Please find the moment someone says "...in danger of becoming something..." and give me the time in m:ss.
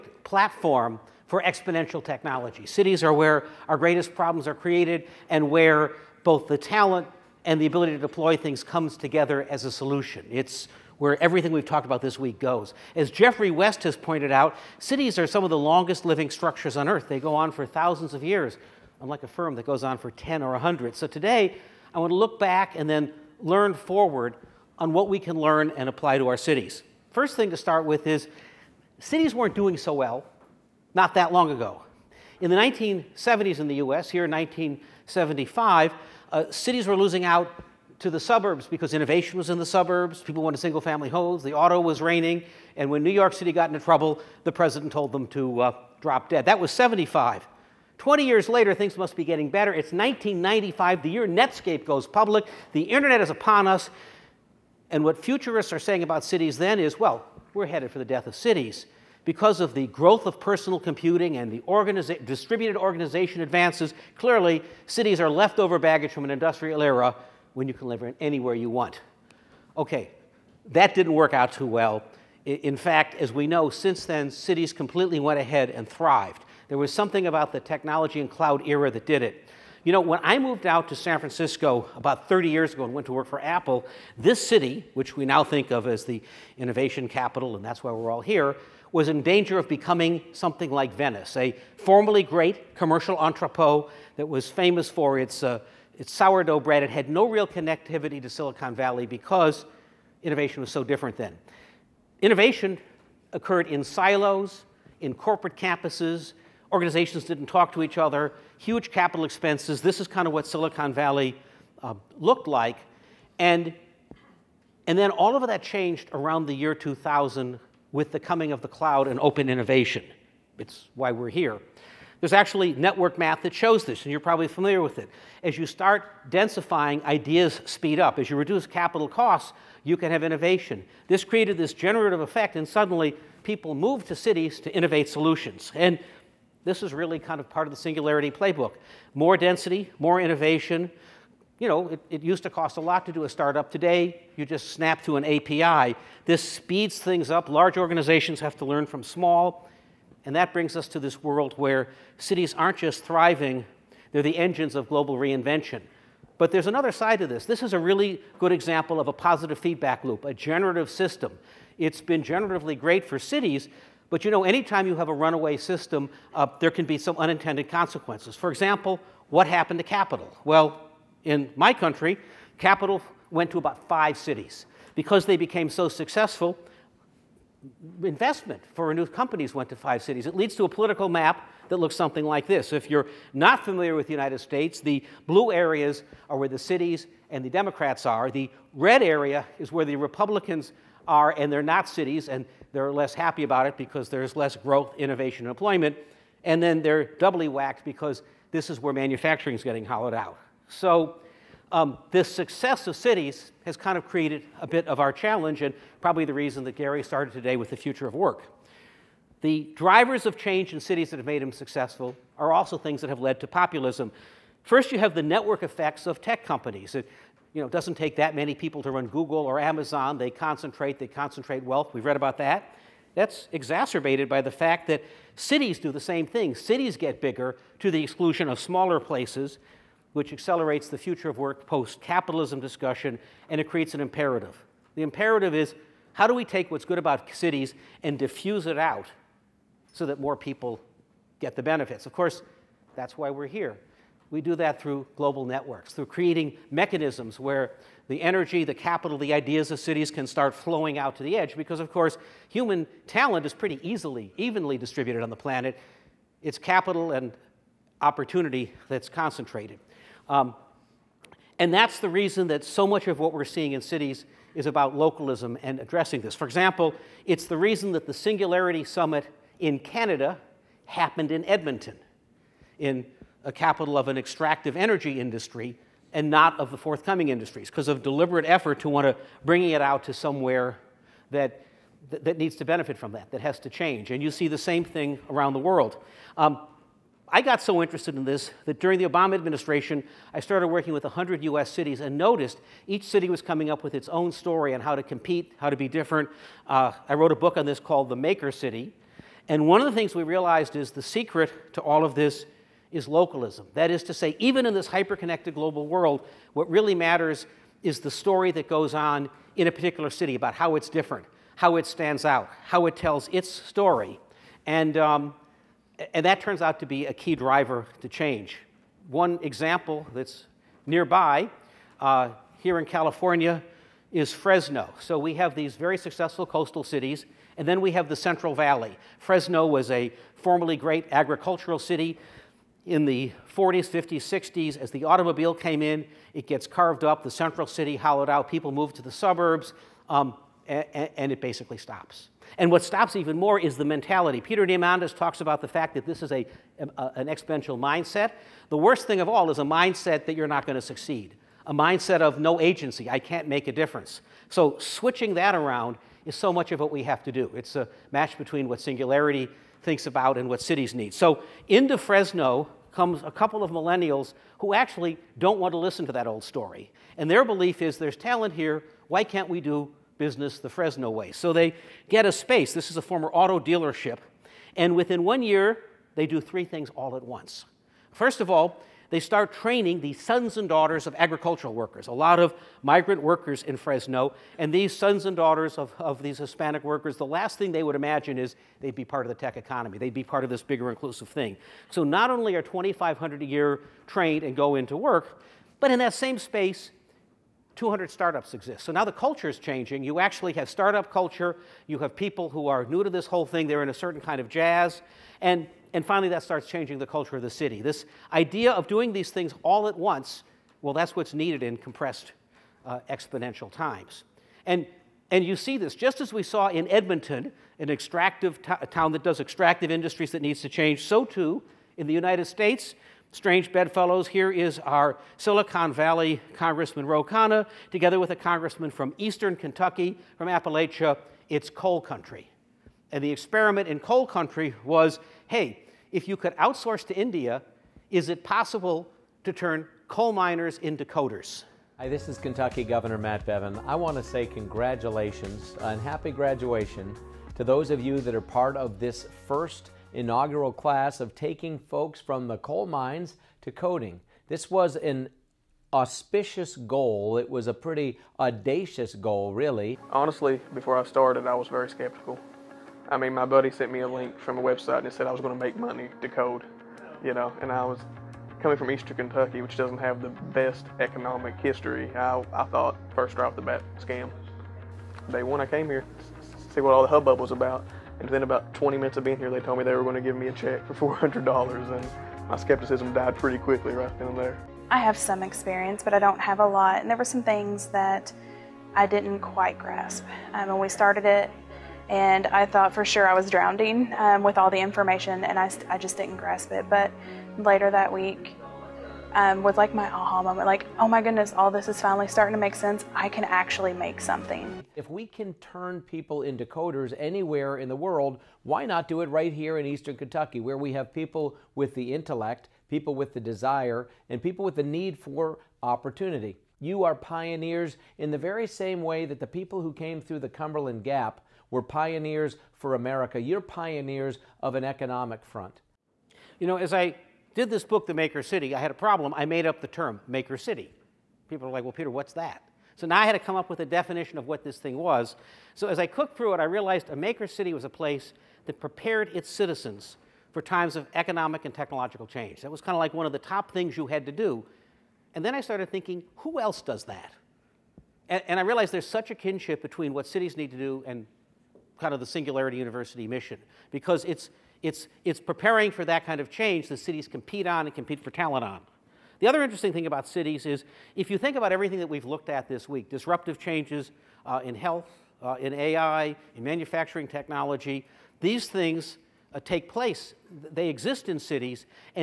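1:29.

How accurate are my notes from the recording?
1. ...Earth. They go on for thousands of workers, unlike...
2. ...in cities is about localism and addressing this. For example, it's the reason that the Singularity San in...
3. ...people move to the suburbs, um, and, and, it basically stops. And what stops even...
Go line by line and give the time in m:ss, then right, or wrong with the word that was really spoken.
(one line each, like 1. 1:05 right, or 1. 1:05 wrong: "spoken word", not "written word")
1. 0:16 wrong: "years", not "workers"
2. 4:23 wrong: "Summit", not "San"
3. 5:38 right.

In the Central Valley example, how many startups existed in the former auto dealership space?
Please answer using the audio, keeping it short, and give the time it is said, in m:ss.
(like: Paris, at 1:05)
200, at 6:37.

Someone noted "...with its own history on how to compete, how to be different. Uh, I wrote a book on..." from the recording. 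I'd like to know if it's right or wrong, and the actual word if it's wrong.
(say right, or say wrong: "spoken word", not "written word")
wrong: "story", not "history".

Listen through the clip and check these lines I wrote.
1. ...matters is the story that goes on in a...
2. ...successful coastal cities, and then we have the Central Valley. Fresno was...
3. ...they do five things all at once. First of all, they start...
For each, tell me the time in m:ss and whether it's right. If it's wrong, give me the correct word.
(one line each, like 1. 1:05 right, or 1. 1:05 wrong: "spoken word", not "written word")
1. 5:06 right
2. 5:25 right
3. 6:16 wrong: "three", not "five".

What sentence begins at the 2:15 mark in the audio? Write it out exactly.
And this is really kind of part of the singularity playbook.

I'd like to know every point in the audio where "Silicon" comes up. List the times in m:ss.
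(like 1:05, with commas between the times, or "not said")
1:38, 1:50, 7:05.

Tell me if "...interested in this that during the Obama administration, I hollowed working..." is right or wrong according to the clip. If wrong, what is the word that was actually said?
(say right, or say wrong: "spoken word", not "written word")
wrong: "started", not "hollowed".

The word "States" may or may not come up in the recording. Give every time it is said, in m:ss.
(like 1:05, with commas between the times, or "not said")
3:04, 7:02.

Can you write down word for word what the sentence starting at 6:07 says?
And their belief is there's talent here, why can't we do business the Fresno way?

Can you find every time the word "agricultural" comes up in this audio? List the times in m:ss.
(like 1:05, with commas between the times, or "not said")
5:31, 6:21.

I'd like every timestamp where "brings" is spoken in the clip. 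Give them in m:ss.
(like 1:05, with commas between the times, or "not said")
2:30, 4:39.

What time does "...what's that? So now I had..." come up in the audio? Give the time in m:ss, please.
8:52.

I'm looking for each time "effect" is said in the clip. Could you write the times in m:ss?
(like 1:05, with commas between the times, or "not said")
2:12, 3:35.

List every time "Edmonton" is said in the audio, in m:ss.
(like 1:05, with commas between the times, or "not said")
4:31, 6:56.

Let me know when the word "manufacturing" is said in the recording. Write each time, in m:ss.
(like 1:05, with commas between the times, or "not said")
3:18, 9:26.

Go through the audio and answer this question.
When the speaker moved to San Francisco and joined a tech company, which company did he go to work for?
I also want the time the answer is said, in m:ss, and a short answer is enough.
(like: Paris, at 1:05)
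Apple, at 1:23.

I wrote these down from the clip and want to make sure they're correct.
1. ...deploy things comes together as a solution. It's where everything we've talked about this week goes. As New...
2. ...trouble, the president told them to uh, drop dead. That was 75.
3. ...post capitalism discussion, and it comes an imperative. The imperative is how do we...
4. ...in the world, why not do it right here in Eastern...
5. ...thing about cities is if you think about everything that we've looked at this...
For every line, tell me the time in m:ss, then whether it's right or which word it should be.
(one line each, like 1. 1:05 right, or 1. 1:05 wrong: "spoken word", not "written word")
1. 0:07 wrong: "Geoffrey", not "New"
2. 0:43 right
3. 3:51 wrong: "creates", not "comes"
4. 8:27 right
5. 9:19 right.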